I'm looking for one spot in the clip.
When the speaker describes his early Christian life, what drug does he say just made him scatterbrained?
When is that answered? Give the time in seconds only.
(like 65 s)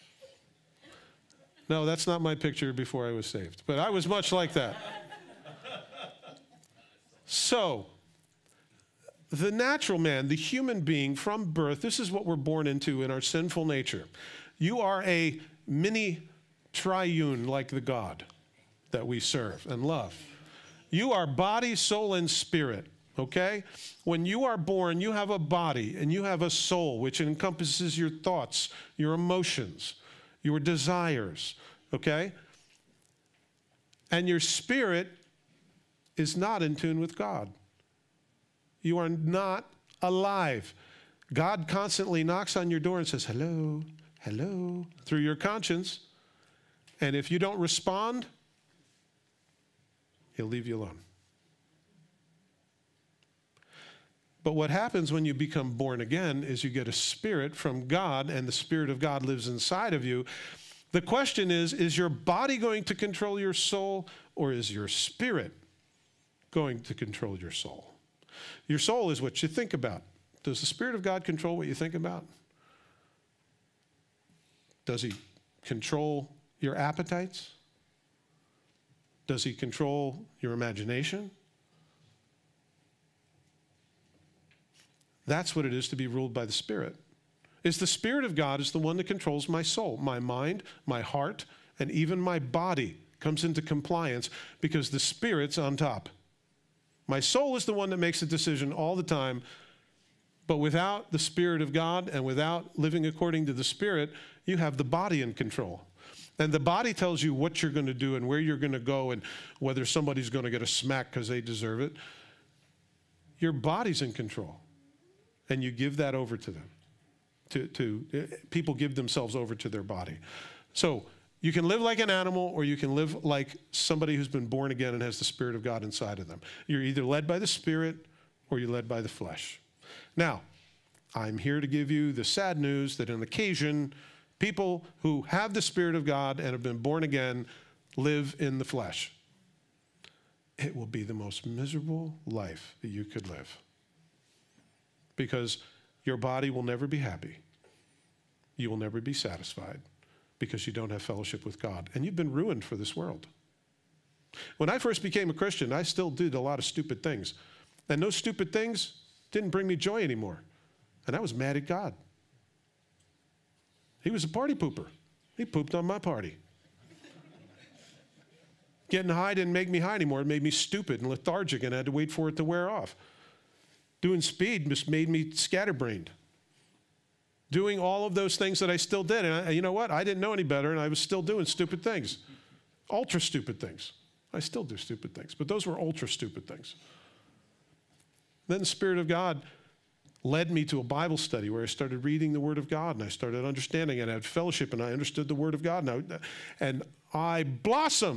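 174 s.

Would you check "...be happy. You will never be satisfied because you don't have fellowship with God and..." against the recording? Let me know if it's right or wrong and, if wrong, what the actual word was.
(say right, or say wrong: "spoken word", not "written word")
right.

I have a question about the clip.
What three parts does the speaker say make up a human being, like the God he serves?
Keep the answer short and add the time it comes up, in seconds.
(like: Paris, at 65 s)
Body, soul, and spirit, at 21 s.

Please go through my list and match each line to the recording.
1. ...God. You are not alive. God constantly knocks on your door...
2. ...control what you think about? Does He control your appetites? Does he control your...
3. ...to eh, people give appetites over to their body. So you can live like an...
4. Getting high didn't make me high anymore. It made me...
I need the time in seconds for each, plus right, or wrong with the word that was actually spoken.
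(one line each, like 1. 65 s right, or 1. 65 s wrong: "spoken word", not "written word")
1. 37 s right
2. 71 s right
3. 117 s wrong: "themselves", not "appetites"
4. 168 s right.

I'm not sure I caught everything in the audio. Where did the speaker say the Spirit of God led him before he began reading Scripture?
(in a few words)
A Bible study.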